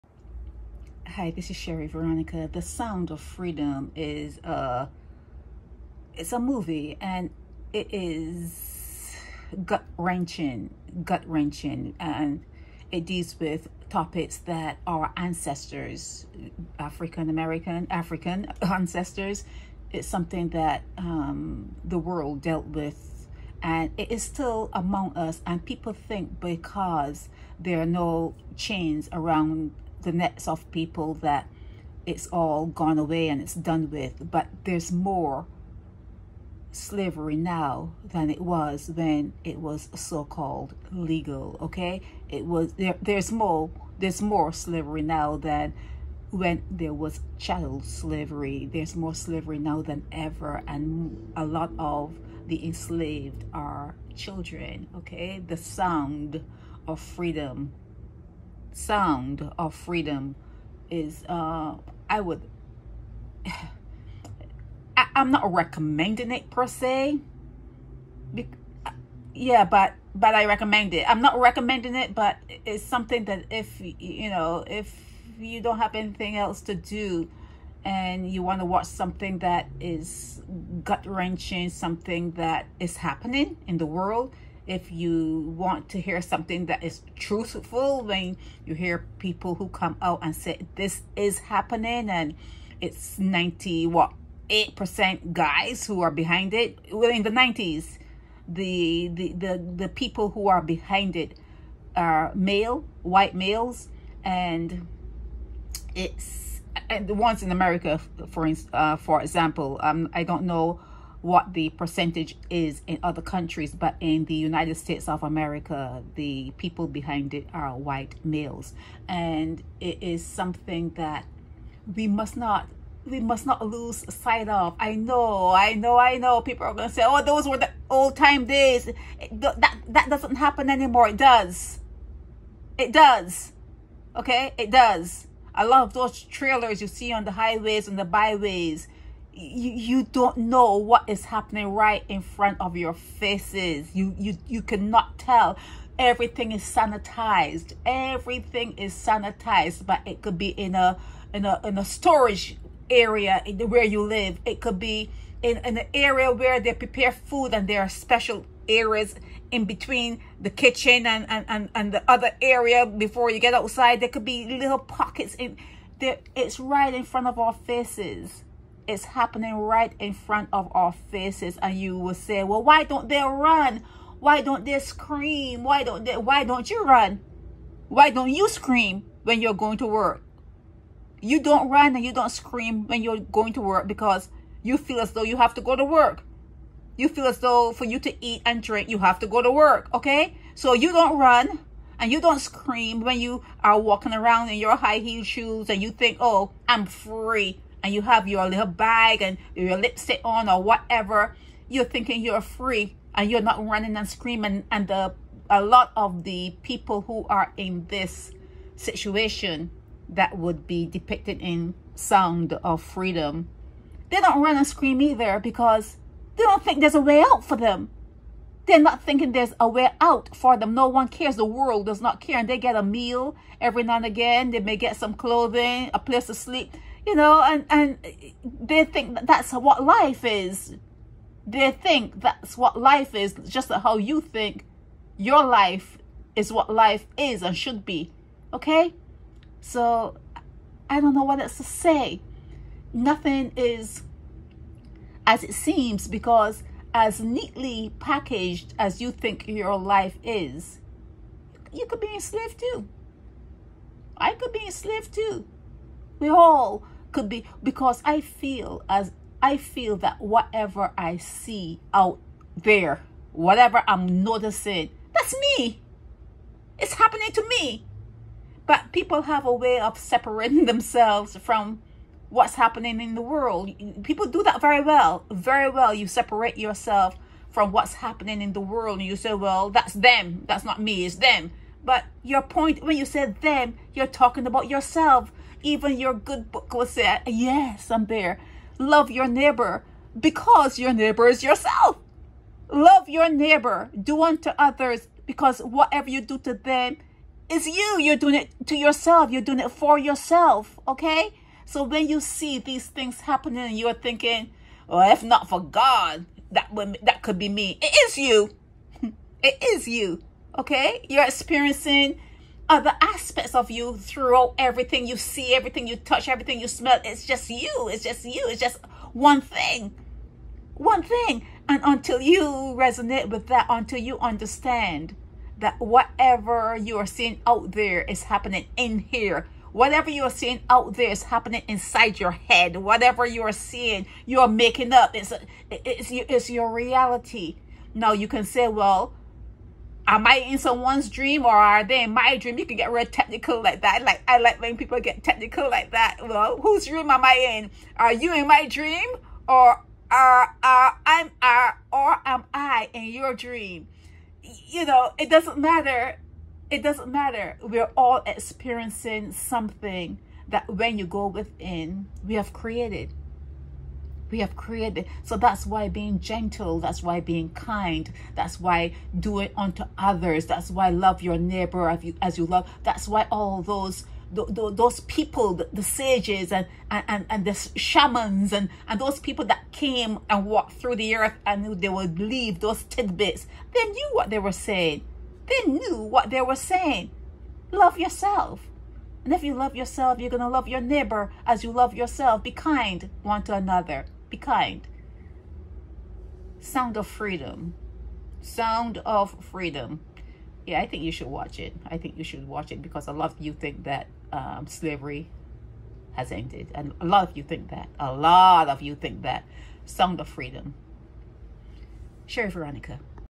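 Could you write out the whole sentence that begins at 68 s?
Be, yeah, but, but I recommend it.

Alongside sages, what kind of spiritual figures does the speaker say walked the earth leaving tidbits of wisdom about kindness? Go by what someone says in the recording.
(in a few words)
shamans.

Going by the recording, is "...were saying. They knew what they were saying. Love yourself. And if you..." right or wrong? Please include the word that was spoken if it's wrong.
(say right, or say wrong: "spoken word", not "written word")
right.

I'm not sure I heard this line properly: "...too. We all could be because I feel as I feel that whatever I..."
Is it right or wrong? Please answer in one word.
right.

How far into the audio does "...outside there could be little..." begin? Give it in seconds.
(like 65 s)
163 s.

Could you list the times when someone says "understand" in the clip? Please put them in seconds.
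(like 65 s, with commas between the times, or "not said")
324 s.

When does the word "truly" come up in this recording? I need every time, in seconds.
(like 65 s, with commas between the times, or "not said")
not said.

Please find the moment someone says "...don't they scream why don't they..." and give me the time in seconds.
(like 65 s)
174 s.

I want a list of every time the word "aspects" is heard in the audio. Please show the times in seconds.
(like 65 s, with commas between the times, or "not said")
313 s.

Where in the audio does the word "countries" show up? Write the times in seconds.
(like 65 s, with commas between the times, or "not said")
113 s.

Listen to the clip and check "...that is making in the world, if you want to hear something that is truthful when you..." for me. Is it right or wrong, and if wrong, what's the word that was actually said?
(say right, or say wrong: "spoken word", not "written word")
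wrong: "happening", not "making".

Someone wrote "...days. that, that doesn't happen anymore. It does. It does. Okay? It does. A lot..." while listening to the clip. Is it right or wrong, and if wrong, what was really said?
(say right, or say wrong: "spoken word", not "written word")
right.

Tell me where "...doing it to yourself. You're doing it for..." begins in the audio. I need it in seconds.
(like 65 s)
298 s.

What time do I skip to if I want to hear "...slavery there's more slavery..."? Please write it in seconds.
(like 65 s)
47 s.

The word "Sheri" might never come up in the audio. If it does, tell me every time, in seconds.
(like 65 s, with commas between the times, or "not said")
1 s, 412 s.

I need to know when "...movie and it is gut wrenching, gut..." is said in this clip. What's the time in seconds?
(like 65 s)
6 s.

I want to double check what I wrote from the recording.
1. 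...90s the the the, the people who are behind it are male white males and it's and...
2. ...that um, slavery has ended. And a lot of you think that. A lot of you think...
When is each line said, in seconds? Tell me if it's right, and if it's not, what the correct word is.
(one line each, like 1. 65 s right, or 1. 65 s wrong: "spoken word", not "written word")
1. 97 s right
2. 403 s right.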